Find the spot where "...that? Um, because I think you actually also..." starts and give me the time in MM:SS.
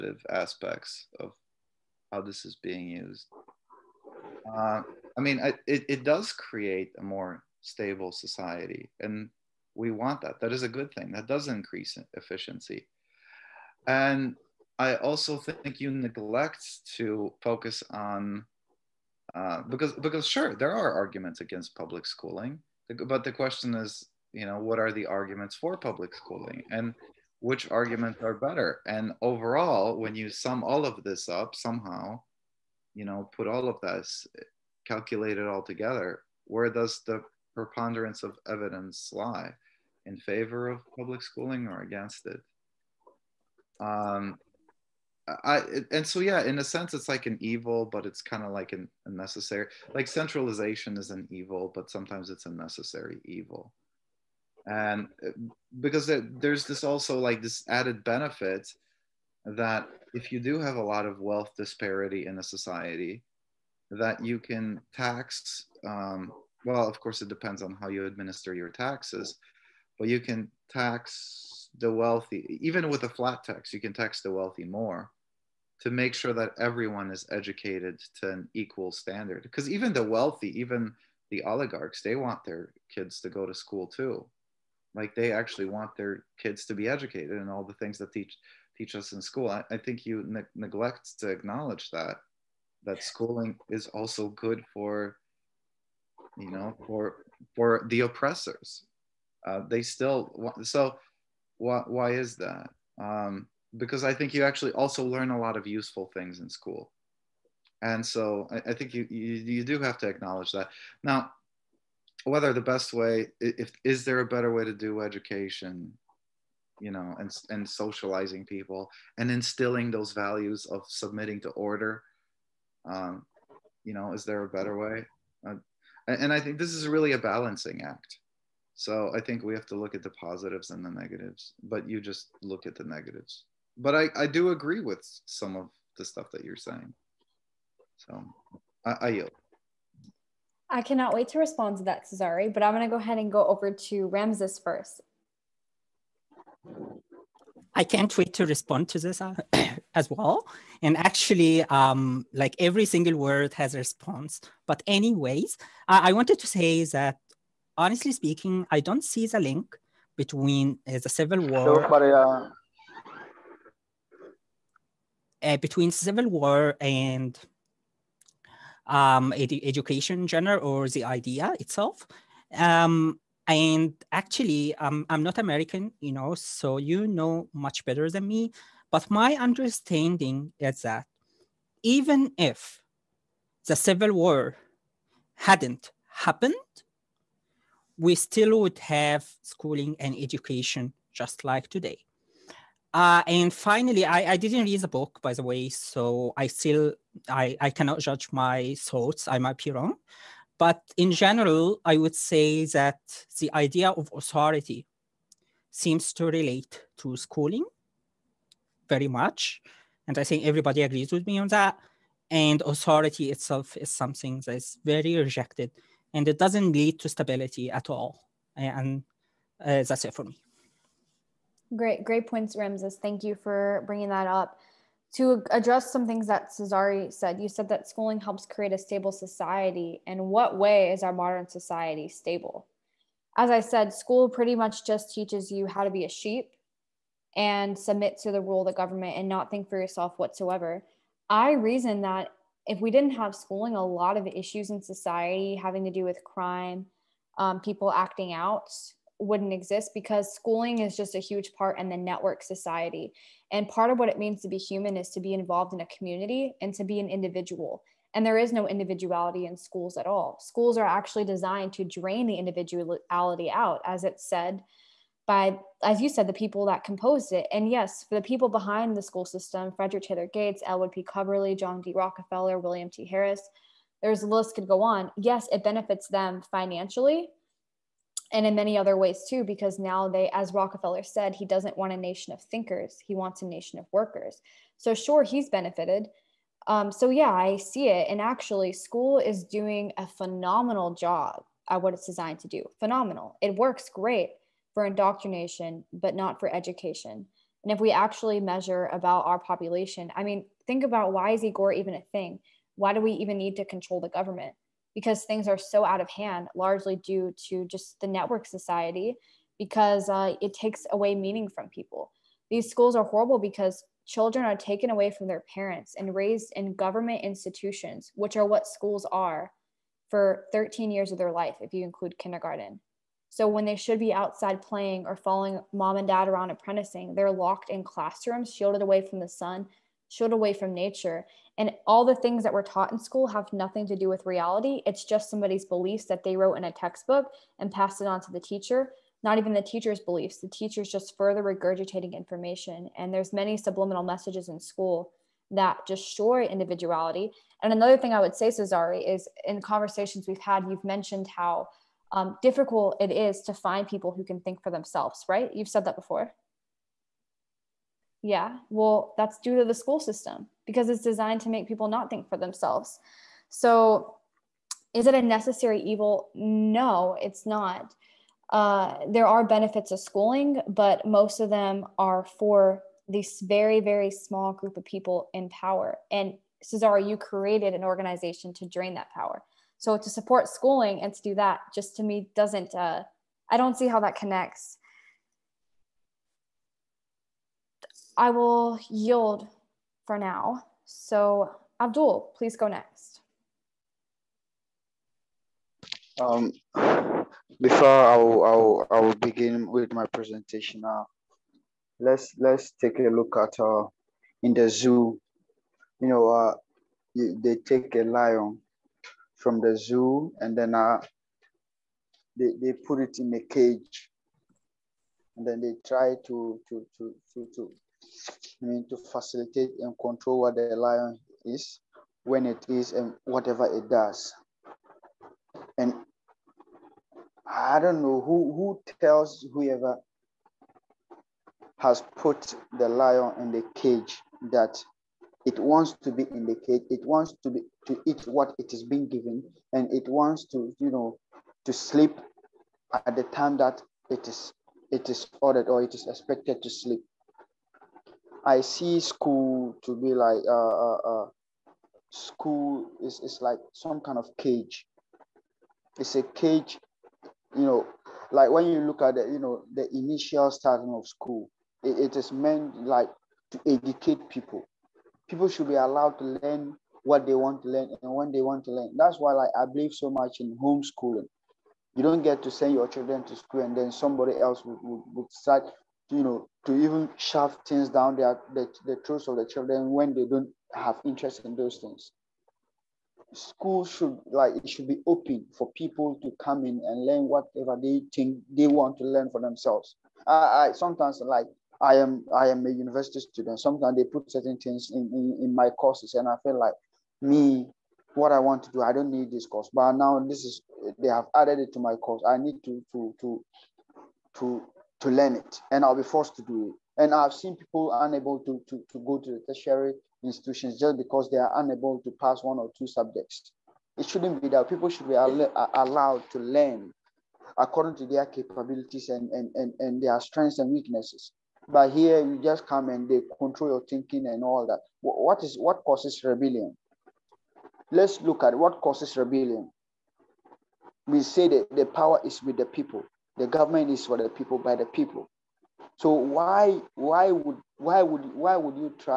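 01:42.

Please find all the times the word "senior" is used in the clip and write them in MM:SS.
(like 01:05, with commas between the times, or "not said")
not said.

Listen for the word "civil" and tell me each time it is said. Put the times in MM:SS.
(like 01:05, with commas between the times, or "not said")
02:41, 02:45, 03:03.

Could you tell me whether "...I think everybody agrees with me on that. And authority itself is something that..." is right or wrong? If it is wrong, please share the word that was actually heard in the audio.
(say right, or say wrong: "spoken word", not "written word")
right.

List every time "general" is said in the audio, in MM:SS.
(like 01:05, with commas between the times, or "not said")
02:50, 03:21.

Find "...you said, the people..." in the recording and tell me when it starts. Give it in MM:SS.
04:26.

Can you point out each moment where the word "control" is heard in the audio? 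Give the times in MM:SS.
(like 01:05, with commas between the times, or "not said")
05:03, 06:59, 08:43.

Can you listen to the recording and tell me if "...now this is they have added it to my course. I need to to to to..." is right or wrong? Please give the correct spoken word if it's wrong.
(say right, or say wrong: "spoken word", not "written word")
right.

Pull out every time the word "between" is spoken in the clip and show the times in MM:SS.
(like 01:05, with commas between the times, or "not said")
02:40, 02:45.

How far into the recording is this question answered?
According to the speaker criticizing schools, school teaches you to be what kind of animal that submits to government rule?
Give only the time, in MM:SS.
03:56.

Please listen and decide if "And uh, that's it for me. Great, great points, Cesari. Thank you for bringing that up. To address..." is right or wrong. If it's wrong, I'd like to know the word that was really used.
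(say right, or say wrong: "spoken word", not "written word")
wrong: "Ramses", not "Cesari".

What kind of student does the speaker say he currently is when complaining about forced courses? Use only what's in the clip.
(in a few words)
university student.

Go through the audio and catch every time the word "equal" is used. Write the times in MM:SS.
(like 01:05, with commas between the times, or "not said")
01:18.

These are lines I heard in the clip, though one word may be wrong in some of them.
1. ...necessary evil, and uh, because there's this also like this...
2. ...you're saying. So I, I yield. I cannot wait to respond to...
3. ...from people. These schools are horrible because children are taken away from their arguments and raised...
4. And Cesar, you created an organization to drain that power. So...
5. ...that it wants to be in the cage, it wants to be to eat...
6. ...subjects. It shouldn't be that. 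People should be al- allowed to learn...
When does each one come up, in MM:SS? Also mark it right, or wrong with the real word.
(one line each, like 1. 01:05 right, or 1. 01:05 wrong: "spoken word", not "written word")
1. 00:52 right
2. 02:16 right
3. 05:11 wrong: "parents", not "arguments"
4. 06:16 right
5. 07:14 right
6. 08:32 right.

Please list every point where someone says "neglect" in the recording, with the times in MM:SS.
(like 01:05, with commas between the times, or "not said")
00:15, 01:30.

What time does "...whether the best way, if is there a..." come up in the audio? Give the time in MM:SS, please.
01:52.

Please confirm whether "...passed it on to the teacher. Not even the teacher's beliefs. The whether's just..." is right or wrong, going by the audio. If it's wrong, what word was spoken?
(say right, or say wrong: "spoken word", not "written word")
wrong: "teacher", not "whether".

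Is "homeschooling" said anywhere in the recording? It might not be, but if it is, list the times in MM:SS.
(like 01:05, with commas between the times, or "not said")
07:50.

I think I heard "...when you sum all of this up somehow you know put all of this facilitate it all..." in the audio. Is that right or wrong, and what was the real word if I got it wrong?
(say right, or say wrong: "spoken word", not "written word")
wrong: "calculate", not "facilitate".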